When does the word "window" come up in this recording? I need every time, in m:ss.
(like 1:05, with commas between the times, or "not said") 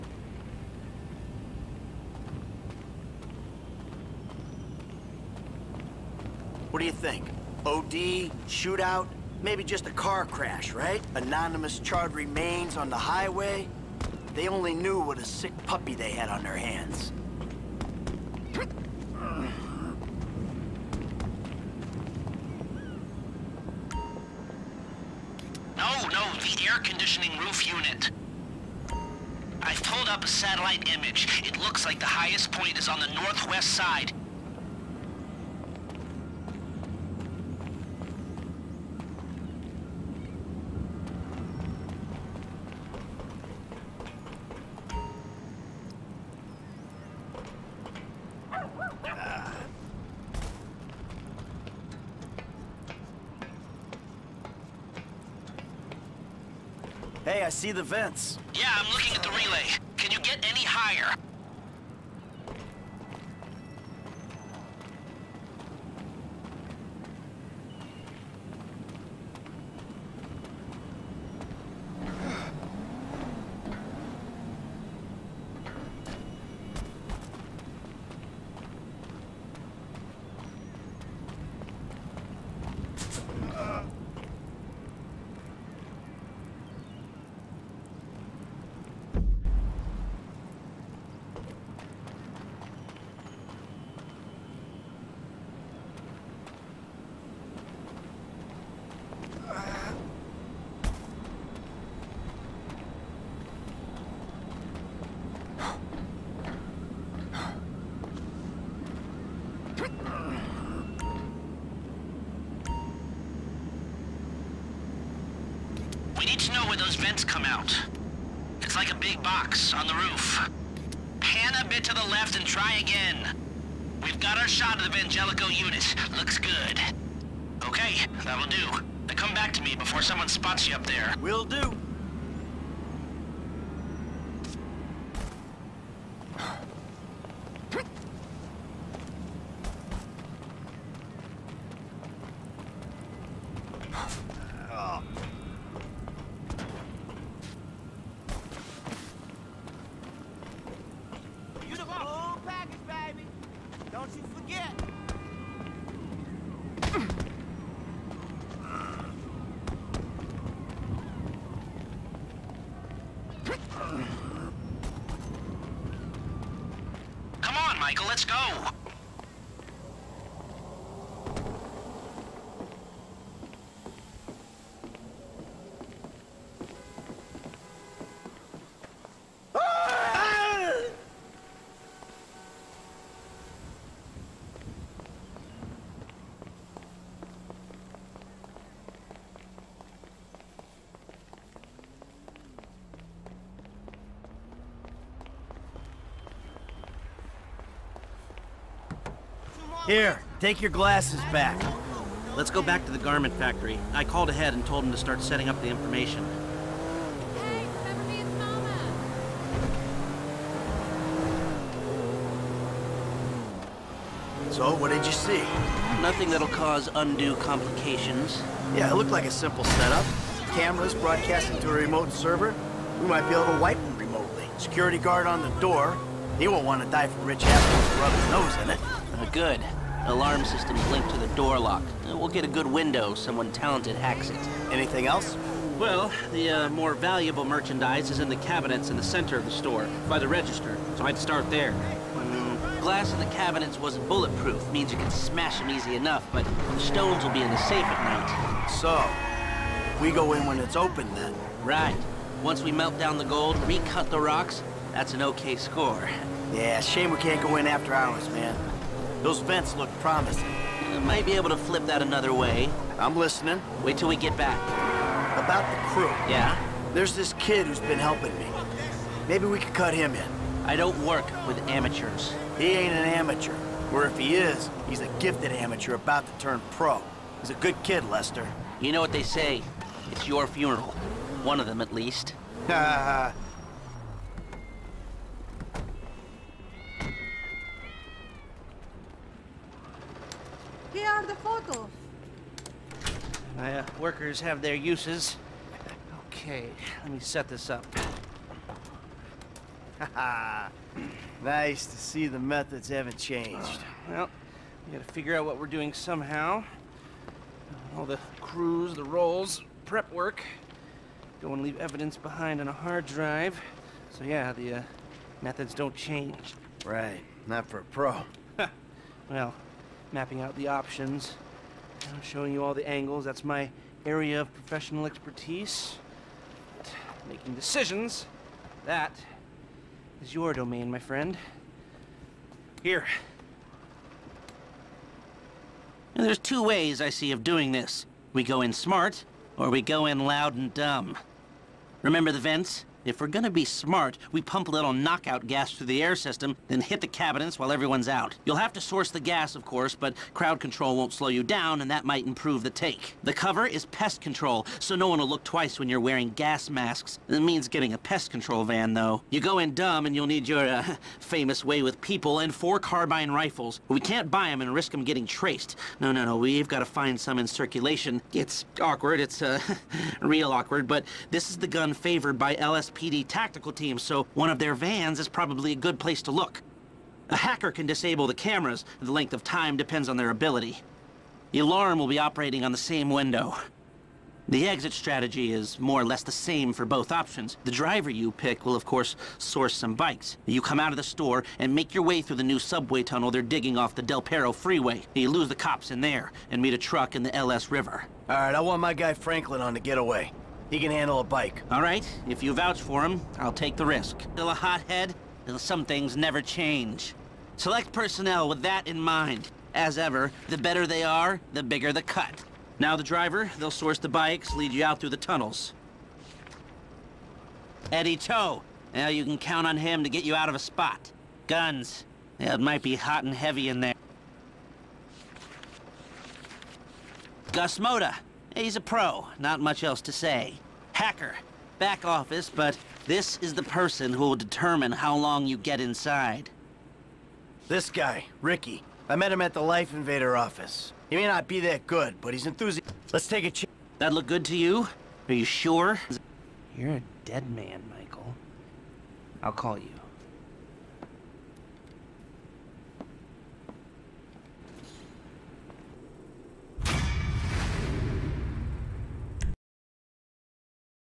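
3:52, 6:23.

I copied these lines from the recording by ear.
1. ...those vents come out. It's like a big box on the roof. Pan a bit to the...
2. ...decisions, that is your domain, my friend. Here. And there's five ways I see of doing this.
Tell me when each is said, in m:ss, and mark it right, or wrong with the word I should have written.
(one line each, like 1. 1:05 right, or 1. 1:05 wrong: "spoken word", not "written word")
1. 1:56 right
2. 5:27 wrong: "two", not "five".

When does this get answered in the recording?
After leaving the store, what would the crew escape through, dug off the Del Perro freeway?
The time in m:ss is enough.
6:32.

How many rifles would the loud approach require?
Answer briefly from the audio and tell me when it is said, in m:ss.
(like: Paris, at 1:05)
4, at 6:02.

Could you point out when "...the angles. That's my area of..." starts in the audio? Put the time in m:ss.
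5:22.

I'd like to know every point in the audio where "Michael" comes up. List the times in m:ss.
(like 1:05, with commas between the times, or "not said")
2:47, 7:27.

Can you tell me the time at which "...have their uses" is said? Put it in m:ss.
4:54.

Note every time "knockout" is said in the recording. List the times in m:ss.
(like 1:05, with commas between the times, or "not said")
5:44.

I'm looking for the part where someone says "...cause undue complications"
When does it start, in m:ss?
3:36.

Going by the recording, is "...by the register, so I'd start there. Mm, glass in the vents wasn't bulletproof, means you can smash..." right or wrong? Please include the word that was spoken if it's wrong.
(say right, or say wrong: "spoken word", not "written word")
wrong: "cabinets", not "vents".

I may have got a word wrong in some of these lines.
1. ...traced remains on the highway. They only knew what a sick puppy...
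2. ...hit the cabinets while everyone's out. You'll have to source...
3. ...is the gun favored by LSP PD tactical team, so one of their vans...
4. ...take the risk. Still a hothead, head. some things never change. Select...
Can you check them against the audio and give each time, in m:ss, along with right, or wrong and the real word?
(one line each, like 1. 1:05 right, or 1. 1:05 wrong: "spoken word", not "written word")
1. 0:11 wrong: "charred", not "traced"
2. 5:46 right
3. 6:11 right
4. 6:43 right.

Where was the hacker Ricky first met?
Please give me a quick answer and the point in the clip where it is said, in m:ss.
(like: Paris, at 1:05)
LifeInvader office, at 7:19.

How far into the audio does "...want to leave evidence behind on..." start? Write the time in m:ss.
5:11.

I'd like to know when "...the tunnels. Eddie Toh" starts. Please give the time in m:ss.
6:55.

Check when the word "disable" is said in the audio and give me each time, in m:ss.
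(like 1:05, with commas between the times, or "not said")
6:17.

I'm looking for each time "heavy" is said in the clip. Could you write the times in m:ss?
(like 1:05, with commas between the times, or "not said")
7:03.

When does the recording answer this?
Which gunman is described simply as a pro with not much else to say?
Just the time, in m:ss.
7:07.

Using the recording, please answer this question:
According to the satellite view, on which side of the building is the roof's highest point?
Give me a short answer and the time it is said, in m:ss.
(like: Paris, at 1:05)
Northwest side, at 0:33.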